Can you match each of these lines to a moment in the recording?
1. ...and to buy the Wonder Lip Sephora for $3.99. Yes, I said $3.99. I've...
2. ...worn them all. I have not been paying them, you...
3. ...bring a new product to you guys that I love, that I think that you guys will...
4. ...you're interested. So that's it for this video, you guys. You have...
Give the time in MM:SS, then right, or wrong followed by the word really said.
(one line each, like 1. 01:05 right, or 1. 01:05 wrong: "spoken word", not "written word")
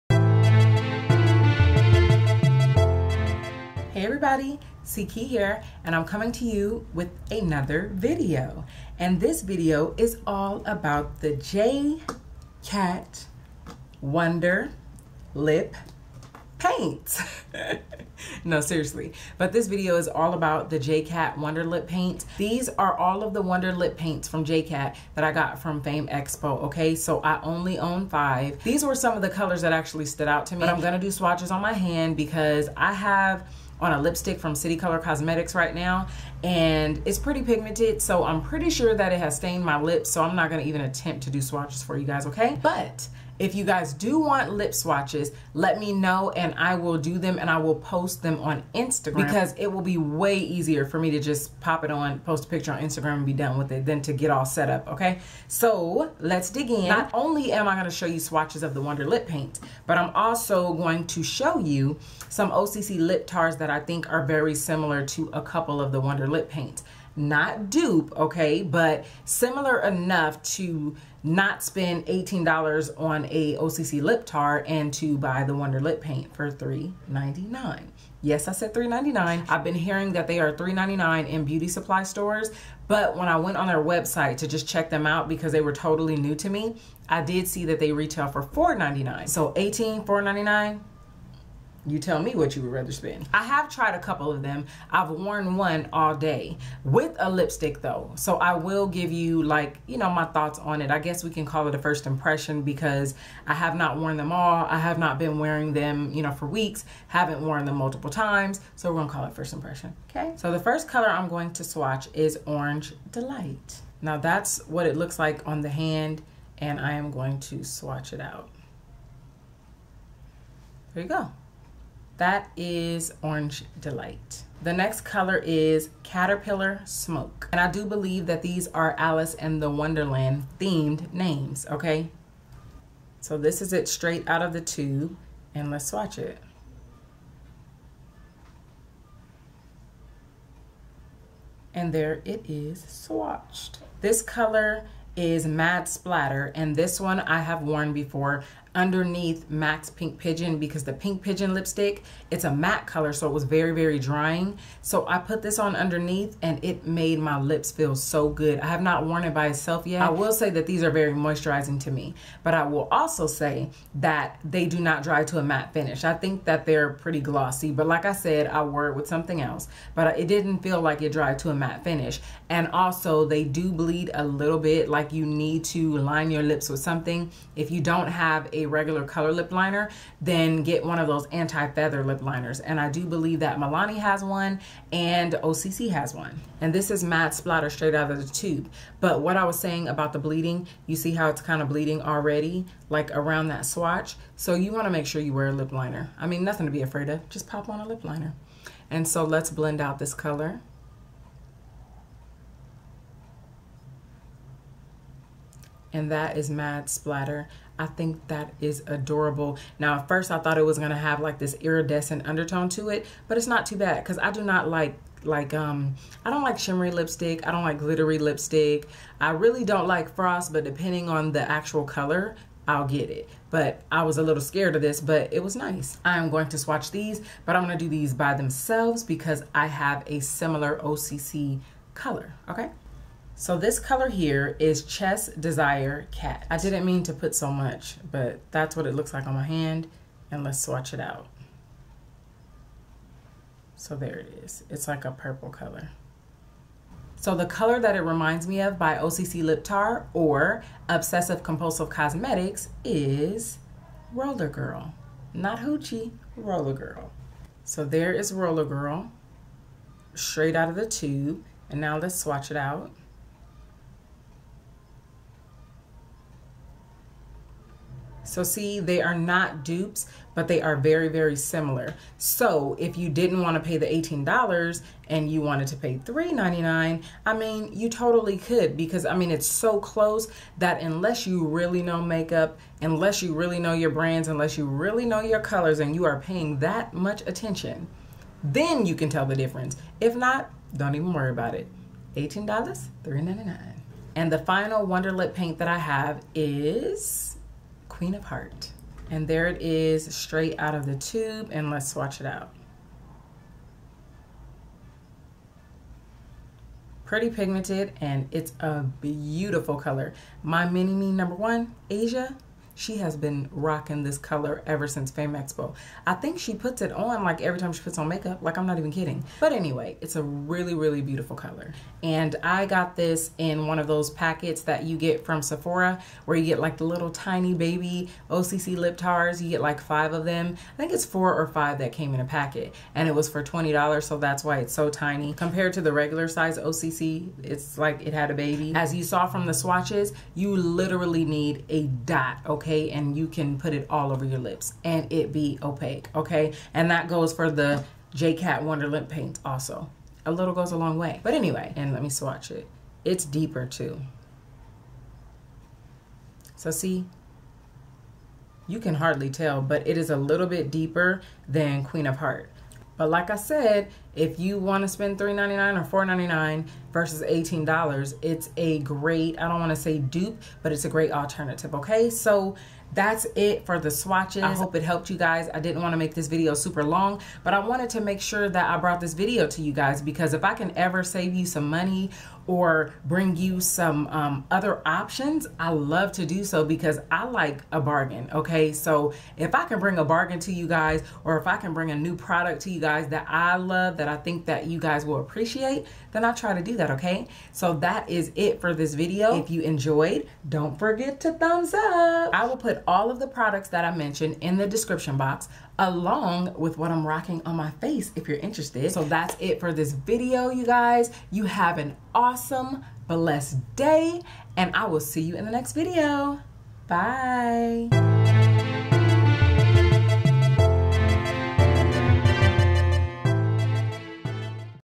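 1. 01:14 wrong: "Paint", not "Sephora"
2. 01:43 wrong: "wearing", not "paying"
3. 06:31 right
4. 06:48 right.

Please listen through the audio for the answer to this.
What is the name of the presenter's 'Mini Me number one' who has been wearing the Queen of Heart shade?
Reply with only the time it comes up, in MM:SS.
05:11.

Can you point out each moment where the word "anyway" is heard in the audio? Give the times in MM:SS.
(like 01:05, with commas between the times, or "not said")
05:19, 05:51.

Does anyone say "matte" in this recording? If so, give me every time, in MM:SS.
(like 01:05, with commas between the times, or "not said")
02:32, 02:45, 02:51.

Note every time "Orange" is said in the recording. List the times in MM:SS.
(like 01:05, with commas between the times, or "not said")
01:52, 02:03.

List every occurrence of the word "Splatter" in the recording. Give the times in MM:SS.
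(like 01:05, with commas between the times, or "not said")
02:25, 03:07, 03:26.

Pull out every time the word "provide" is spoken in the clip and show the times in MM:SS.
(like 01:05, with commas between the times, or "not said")
not said.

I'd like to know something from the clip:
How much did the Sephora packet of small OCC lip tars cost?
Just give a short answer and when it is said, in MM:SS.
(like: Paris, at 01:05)
$20, at 05:33.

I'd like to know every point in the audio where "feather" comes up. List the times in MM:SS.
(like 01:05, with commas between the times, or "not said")
03:01.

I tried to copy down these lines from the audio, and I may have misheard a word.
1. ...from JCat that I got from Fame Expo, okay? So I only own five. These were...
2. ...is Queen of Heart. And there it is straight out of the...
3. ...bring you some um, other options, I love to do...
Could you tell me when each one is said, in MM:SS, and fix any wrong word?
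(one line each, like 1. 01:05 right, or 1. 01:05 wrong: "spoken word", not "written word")
1. 00:24 right
2. 04:56 right
3. 06:23 right.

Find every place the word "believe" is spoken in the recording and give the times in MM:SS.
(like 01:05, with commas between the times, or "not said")
02:07, 03:03.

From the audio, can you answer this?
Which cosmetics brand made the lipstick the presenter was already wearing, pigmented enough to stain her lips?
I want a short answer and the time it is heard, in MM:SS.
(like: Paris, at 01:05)
City Color Cosmetics, at 00:34.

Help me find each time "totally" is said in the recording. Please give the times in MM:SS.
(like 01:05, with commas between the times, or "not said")
01:25, 04:37.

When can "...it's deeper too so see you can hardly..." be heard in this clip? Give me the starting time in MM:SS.
05:53.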